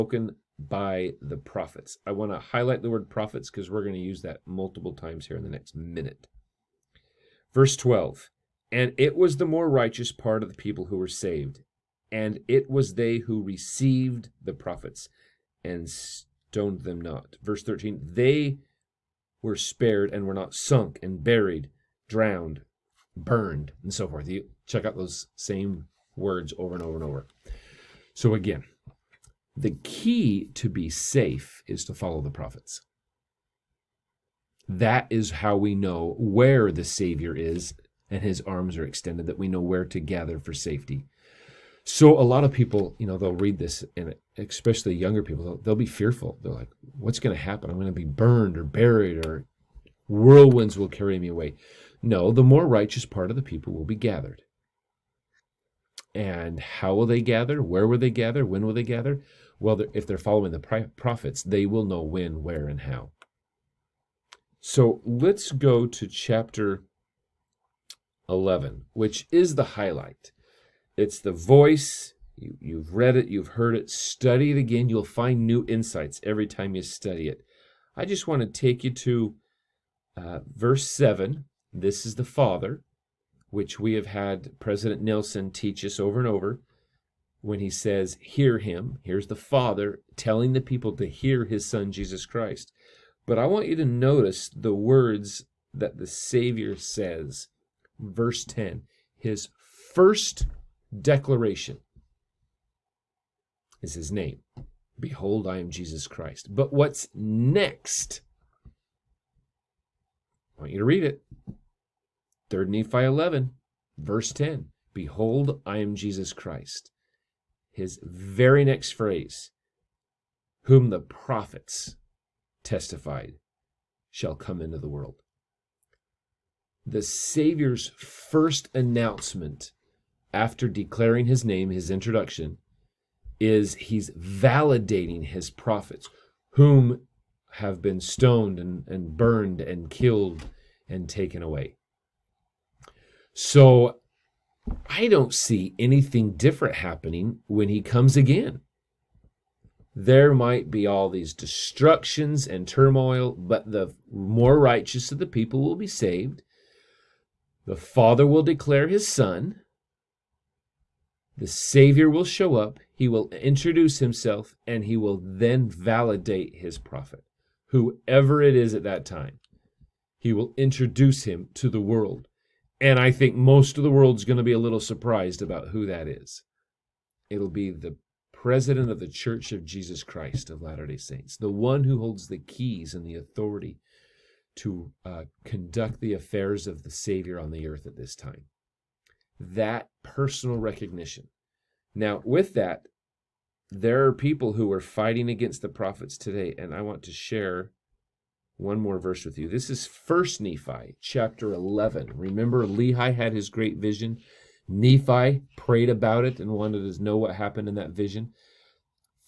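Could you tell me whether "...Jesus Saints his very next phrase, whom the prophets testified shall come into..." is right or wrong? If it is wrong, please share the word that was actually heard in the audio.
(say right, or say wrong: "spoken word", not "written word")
wrong: "Christ", not "Saints".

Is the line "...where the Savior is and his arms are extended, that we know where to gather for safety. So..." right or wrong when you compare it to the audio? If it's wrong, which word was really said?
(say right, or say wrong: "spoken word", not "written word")
right.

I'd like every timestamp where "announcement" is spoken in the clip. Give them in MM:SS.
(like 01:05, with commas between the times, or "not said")
02:08.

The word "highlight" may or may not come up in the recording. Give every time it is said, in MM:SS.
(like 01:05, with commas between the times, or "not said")
00:02, 01:09.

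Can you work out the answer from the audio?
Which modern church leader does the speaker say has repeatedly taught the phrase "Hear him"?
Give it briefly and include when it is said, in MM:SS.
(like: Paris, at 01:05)
President Nelson, at 01:24.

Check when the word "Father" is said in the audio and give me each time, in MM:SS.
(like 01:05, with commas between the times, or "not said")
01:22, 01:29, 02:37.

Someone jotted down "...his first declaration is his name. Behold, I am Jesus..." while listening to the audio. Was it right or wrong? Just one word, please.
right.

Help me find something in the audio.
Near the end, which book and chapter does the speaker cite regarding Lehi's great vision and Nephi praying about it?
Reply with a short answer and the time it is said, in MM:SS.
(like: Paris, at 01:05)
First Nephi 11, at 03:19.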